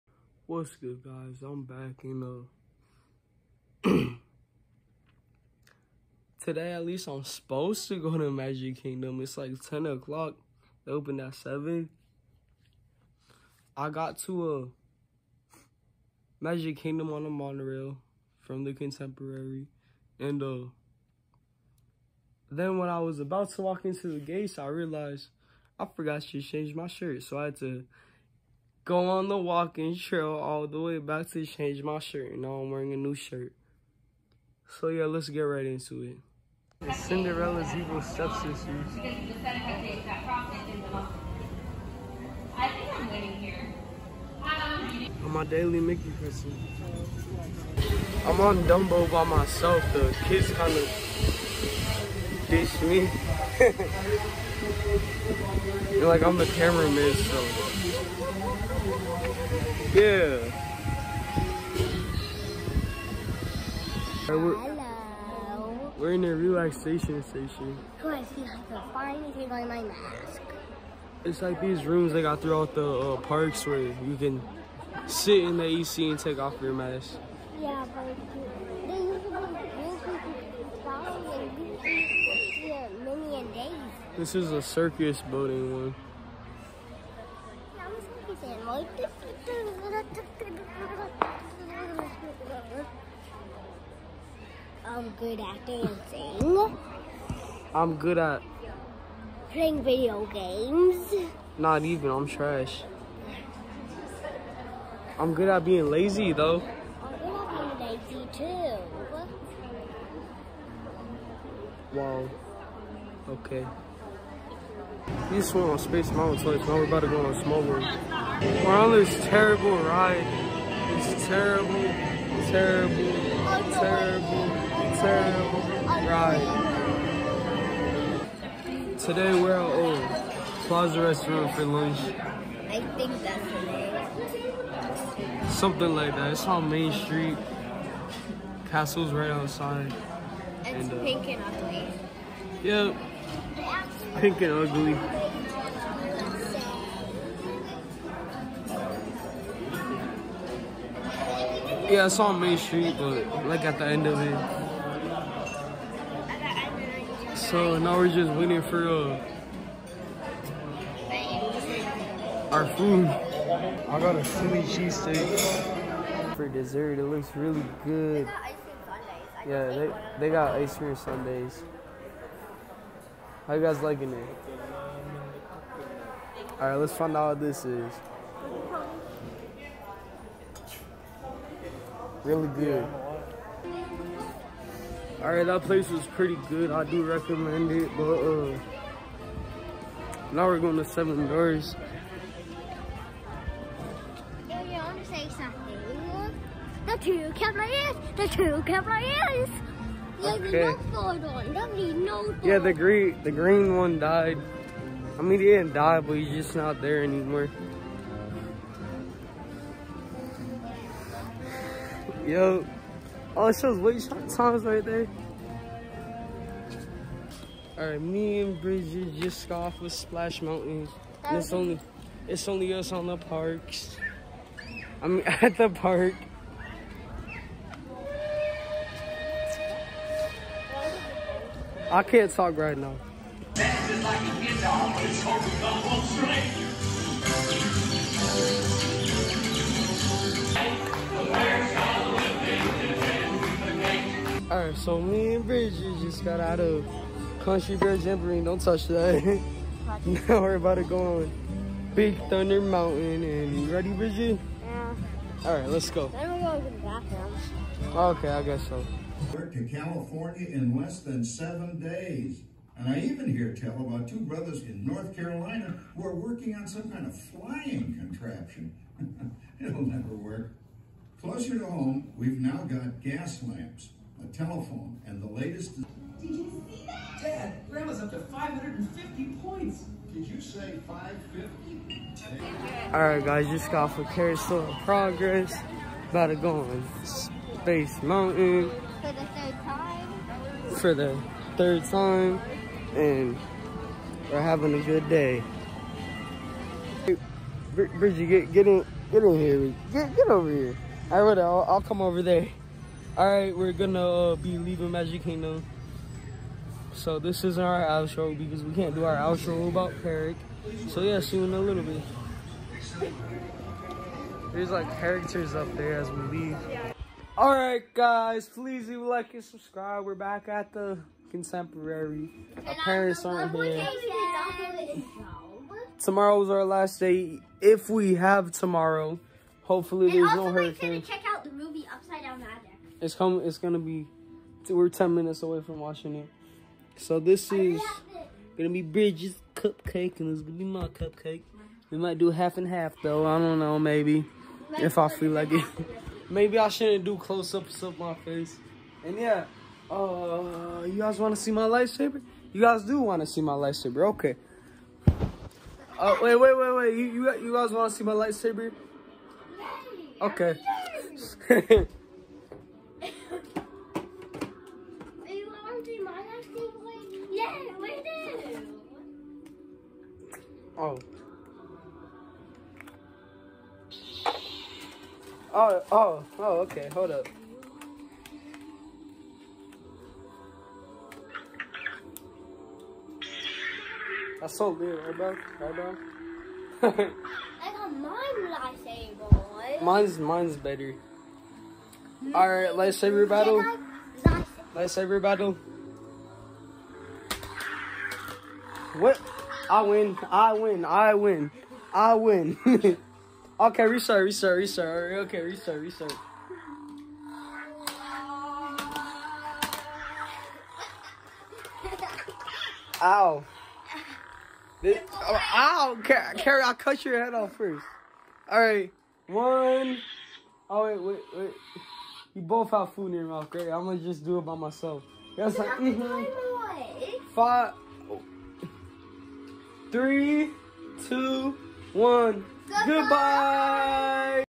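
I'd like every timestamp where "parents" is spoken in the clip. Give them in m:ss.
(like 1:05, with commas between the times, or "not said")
5:22.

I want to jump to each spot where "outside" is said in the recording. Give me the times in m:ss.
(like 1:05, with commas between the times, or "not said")
2:19.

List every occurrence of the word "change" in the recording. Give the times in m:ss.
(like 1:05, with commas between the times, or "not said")
0:26, 0:31.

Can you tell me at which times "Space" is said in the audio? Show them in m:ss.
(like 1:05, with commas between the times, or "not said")
1:55, 4:47.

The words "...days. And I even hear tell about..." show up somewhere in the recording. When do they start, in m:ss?
4:21.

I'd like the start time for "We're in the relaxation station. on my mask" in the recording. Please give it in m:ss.
1:05.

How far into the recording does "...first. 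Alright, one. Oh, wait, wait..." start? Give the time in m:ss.
6:57.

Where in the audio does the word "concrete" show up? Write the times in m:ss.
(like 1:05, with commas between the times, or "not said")
not said.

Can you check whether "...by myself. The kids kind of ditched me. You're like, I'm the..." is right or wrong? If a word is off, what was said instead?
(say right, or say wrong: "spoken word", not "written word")
right.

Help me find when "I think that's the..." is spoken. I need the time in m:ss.
2:11.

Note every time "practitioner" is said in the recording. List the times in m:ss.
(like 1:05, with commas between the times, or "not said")
not said.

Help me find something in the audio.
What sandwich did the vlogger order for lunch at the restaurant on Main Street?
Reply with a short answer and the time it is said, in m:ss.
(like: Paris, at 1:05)
Philly cheesesteak, at 2:44.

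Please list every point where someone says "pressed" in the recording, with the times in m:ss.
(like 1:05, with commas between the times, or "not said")
not said.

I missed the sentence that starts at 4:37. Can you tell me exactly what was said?
Dad, Grandma's up to 550 points.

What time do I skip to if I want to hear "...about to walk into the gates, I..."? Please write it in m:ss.
0:23.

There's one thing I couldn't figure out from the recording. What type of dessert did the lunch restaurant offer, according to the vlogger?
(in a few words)
Ice cream sundaes.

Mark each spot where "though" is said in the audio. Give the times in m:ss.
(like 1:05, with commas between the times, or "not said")
1:46, 5:43.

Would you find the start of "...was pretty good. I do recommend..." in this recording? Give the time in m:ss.
3:05.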